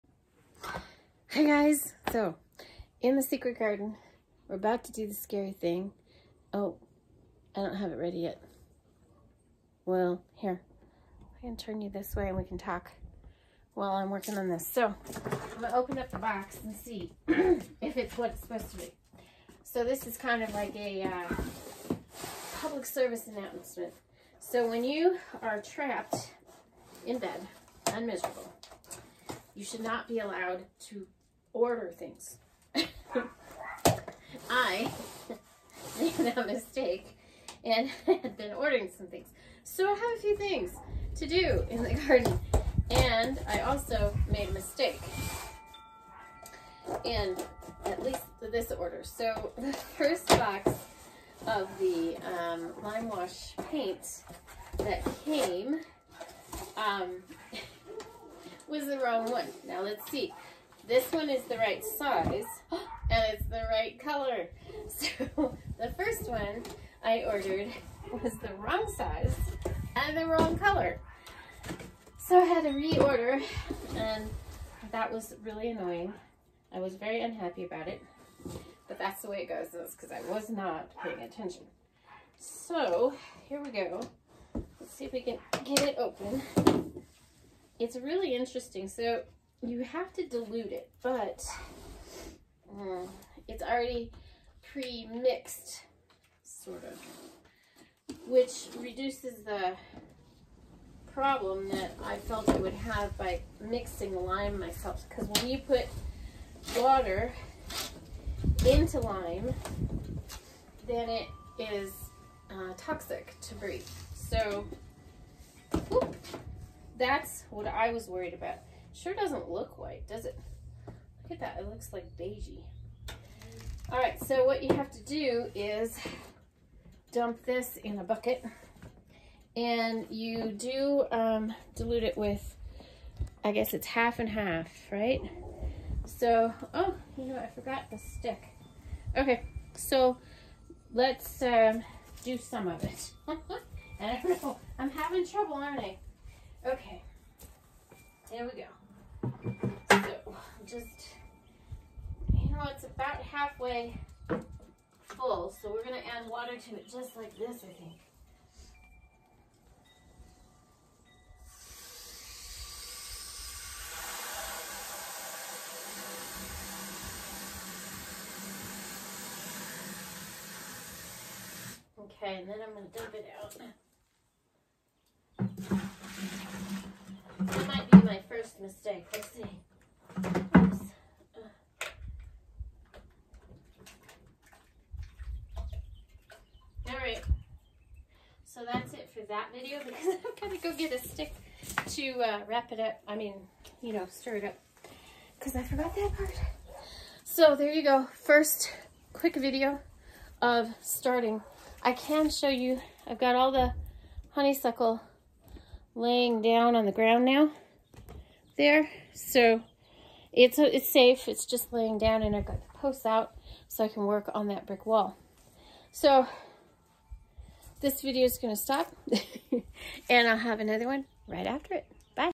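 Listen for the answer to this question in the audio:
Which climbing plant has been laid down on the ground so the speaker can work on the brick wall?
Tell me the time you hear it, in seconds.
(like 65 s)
204 s.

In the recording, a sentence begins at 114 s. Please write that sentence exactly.
So, whoop, that's what I was worried about.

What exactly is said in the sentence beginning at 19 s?
So this is kind of like a uh, public service announcement.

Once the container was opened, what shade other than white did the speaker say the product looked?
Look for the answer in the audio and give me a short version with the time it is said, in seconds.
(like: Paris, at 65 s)
Beigey, at 122 s.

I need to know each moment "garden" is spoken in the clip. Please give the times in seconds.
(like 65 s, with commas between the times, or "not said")
3 s, 42 s.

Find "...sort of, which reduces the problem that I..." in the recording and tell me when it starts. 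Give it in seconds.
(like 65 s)
96 s.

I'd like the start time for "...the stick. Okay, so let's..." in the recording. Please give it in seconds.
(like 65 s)
137 s.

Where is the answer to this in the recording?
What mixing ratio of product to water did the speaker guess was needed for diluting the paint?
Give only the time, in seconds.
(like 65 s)
133 s.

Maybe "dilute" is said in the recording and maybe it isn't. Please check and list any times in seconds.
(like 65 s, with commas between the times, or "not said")
90 s, 131 s.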